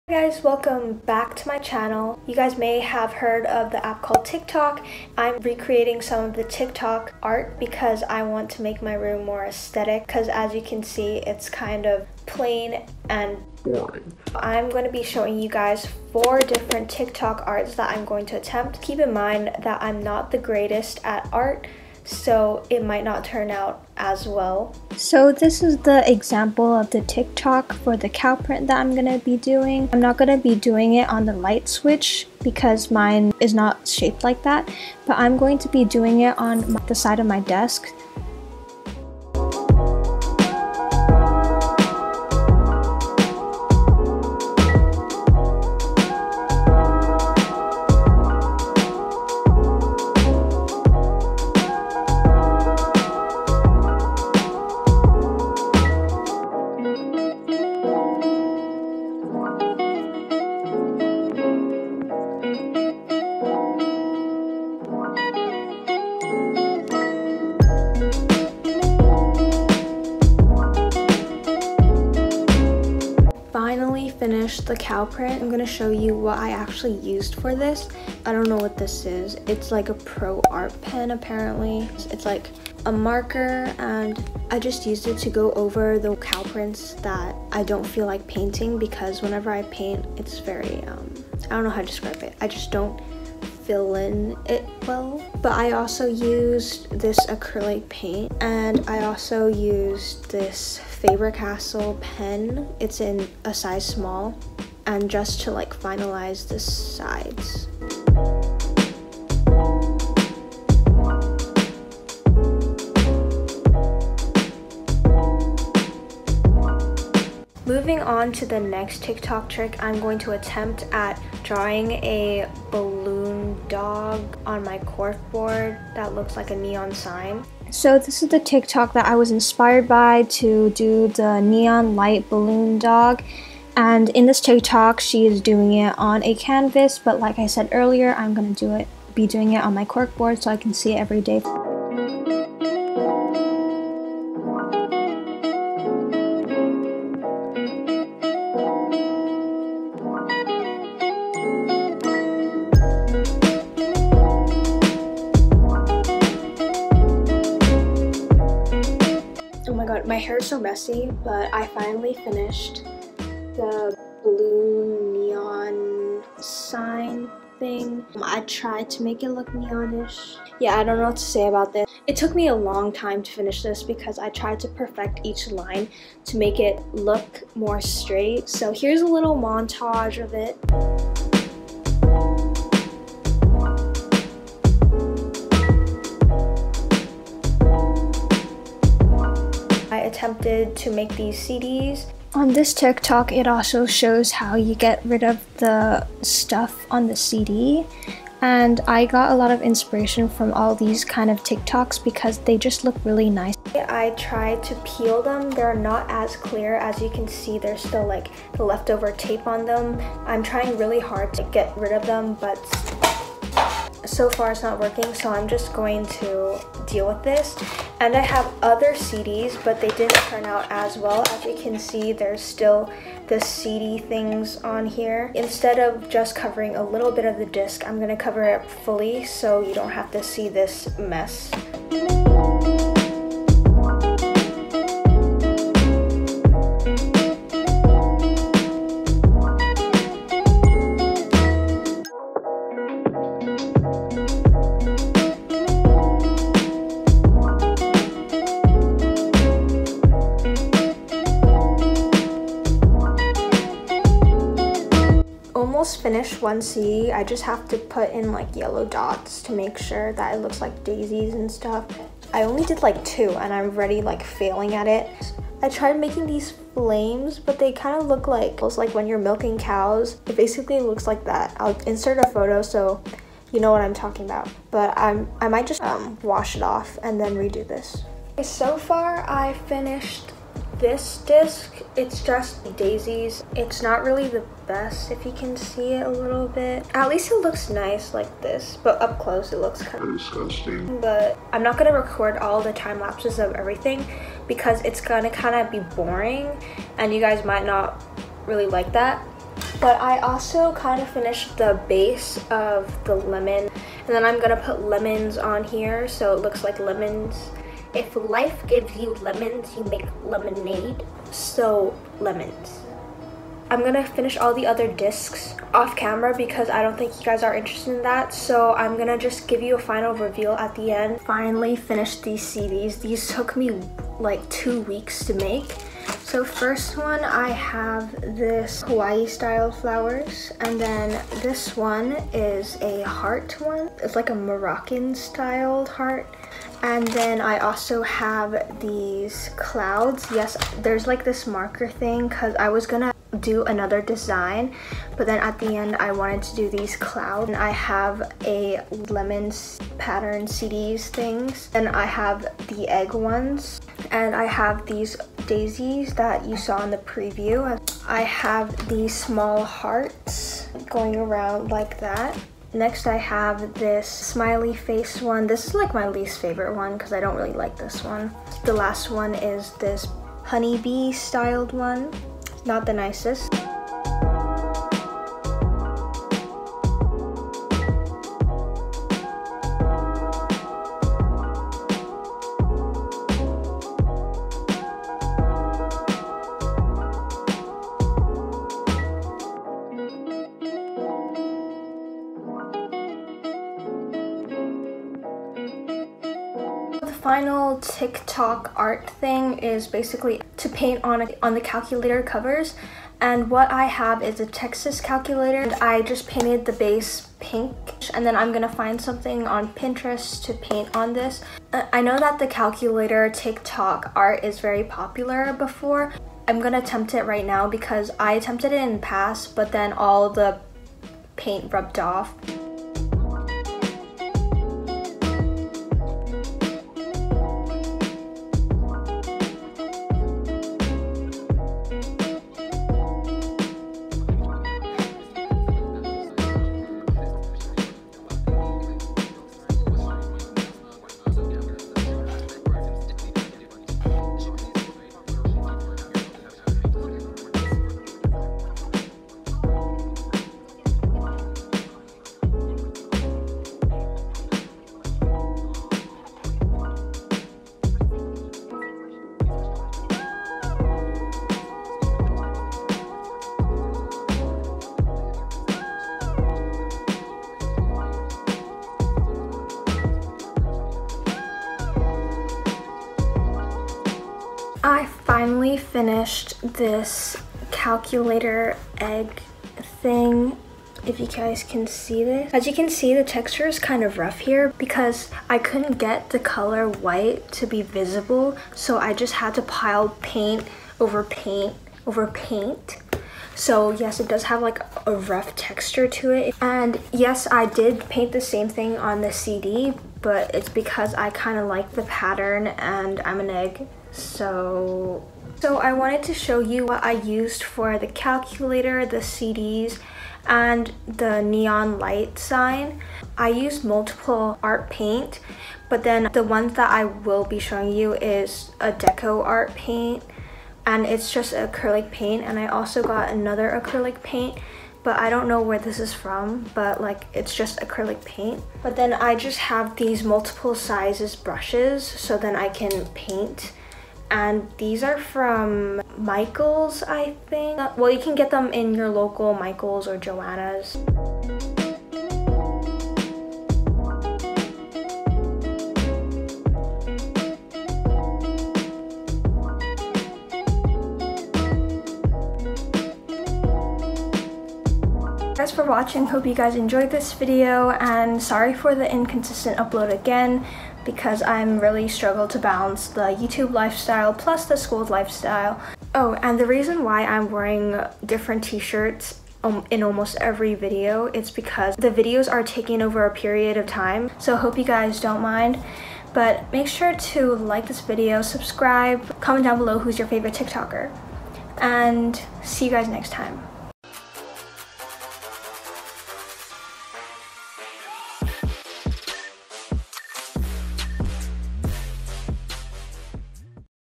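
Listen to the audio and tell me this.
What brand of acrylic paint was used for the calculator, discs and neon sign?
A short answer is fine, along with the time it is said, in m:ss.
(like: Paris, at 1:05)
Deco Art, at 8:38.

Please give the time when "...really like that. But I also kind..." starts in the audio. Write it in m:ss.
4:58.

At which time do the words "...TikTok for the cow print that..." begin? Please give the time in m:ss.
0:27.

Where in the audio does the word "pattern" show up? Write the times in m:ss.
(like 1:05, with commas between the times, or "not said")
5:49, 8:22.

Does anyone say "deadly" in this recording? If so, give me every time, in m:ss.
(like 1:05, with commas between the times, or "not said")
not said.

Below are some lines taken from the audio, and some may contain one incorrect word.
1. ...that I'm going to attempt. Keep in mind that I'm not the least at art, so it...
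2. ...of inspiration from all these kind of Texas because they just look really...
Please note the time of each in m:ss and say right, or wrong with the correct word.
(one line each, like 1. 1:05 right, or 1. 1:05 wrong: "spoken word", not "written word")
1. 0:17 wrong: "greatest", not "least"
2. 3:19 wrong: "TikToks", not "Texas".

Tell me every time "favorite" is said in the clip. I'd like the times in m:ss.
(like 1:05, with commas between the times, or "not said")
6:06, 9:40.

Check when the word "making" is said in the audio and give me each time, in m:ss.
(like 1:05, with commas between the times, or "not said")
4:25.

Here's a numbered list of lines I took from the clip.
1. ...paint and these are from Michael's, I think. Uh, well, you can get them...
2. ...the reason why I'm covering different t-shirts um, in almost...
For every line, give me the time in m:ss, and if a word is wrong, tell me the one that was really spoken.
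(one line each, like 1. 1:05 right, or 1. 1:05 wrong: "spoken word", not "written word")
1. 8:53 right
2. 9:26 wrong: "wearing", not "covering".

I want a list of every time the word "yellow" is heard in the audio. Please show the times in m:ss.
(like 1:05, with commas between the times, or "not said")
4:18.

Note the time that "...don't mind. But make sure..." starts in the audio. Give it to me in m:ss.
9:35.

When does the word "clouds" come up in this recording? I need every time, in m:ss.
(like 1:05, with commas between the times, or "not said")
5:39, 5:46.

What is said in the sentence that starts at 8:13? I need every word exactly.
So yes, it does have like a rough texture to it.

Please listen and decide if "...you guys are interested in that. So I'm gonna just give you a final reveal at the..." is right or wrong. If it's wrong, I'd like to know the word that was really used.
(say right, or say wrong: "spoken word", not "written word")
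right.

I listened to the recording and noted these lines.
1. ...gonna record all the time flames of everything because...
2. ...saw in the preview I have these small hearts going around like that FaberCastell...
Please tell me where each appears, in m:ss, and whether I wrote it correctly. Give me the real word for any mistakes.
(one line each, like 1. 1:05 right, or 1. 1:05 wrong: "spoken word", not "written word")
1. 4:51 wrong: "lapses", not "flames"
2. 5:56 wrong: "Next", not "FaberCastell".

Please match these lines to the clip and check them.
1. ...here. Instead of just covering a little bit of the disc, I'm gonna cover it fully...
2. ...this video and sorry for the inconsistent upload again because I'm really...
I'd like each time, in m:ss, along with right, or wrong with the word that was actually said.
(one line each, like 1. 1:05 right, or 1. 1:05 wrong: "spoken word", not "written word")
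1. 3:44 right
2. 9:17 right.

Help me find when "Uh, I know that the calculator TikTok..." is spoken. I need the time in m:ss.
6:51.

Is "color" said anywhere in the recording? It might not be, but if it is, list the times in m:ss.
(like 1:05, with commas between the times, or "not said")
8:06.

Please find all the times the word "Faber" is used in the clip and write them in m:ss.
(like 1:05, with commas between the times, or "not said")
1:41.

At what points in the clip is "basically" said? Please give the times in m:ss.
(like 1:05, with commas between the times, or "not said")
4:30, 6:39.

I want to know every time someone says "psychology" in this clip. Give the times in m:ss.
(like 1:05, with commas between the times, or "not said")
not said.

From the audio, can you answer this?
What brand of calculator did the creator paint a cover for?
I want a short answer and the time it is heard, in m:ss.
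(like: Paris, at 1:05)
Texas, at 6:44.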